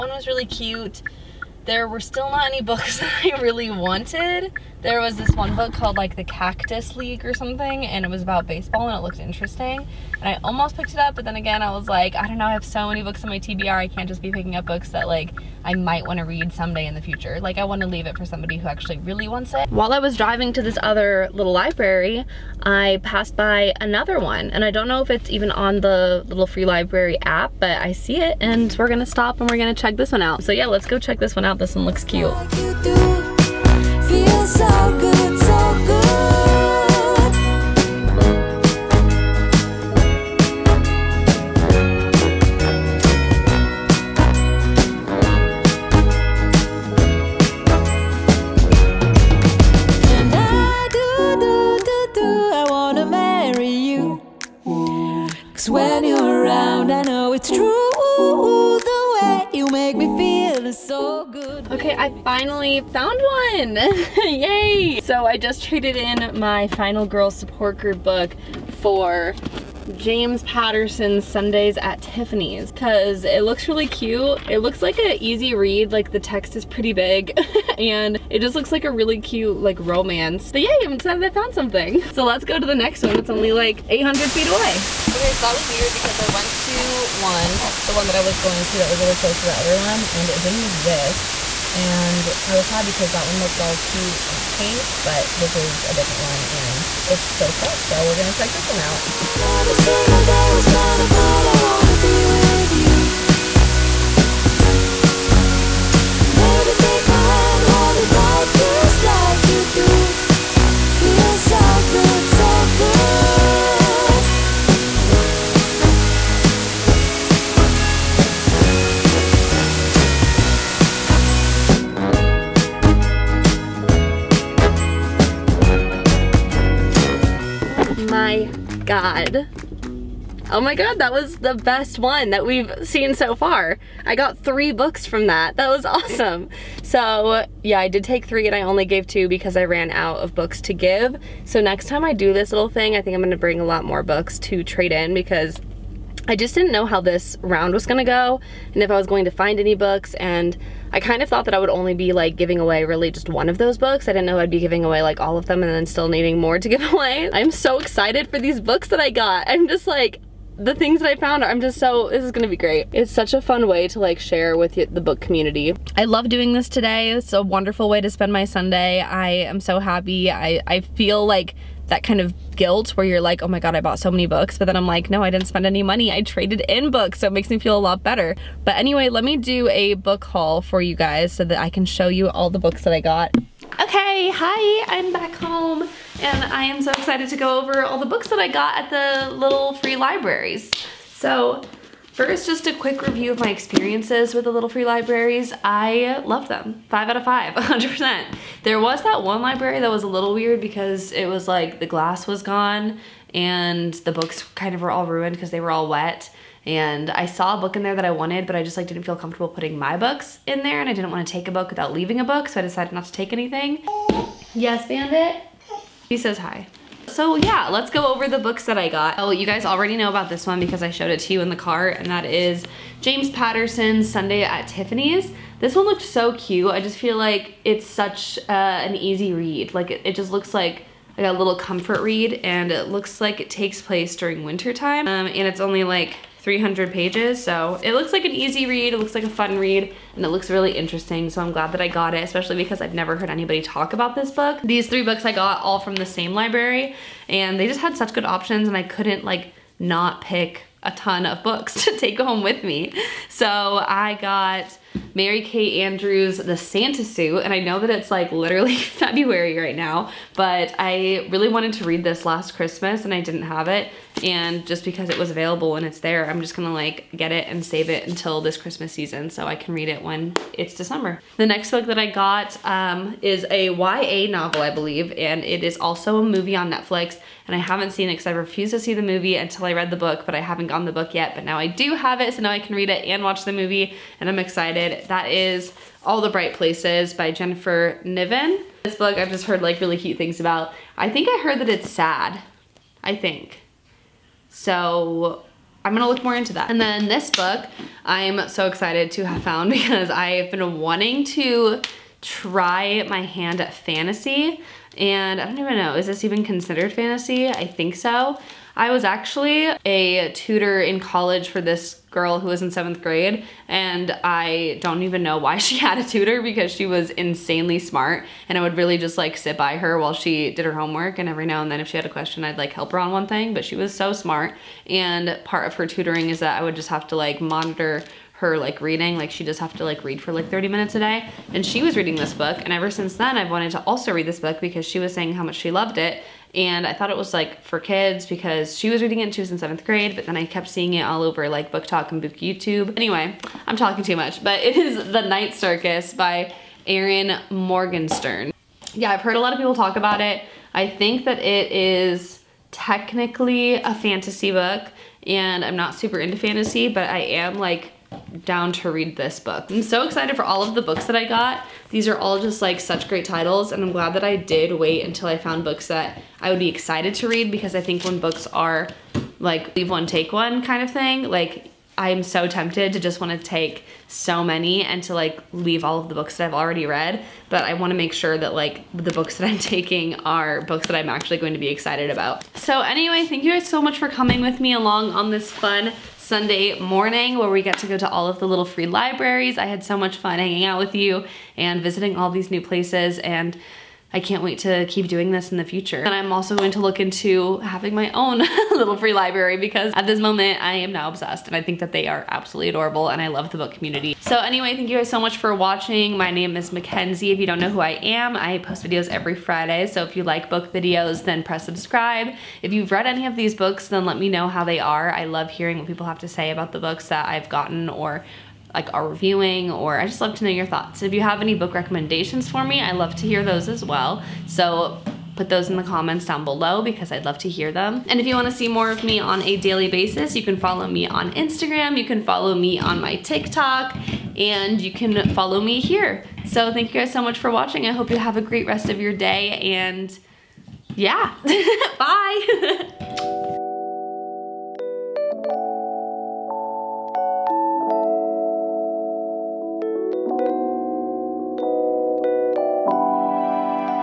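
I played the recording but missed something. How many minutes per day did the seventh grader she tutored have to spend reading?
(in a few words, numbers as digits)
30.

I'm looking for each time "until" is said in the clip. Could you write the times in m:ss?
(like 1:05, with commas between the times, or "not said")
4:28, 4:39, 6:05.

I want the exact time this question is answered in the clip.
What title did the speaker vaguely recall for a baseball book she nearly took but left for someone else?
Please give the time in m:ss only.
0:06.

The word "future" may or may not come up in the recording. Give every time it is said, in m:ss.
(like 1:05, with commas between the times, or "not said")
0:17, 6:35.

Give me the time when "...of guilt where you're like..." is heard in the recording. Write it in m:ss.
2:52.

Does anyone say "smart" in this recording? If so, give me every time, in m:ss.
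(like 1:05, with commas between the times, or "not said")
5:17, 5:24.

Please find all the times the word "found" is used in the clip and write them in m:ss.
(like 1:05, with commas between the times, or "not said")
1:02, 1:21, 2:41, 4:59, 6:05.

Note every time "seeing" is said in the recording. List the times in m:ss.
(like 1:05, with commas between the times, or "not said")
5:40.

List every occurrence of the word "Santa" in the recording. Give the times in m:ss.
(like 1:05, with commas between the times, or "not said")
4:16.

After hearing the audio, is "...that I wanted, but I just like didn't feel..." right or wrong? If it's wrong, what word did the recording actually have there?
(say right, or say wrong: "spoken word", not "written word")
right.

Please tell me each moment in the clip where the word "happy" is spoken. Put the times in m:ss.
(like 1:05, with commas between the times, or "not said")
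1:32, 2:49.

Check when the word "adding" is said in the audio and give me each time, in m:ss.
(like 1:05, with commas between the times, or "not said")
not said.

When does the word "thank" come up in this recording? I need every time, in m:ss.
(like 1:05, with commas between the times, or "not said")
6:23, 6:44, 7:16.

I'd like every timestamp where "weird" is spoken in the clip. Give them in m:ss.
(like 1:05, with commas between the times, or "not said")
1:25, 3:20.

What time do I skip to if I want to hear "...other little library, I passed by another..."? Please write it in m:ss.
0:20.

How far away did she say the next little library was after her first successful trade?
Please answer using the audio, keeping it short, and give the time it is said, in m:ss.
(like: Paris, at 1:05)
800 feet, at 1:23.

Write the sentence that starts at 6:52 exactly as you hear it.
If you've read any of these books, then let me know how they are.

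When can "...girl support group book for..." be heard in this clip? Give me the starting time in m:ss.
1:07.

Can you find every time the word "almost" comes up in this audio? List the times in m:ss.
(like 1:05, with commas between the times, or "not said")
0:10.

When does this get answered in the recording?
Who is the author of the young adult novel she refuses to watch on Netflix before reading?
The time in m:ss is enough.
4:47.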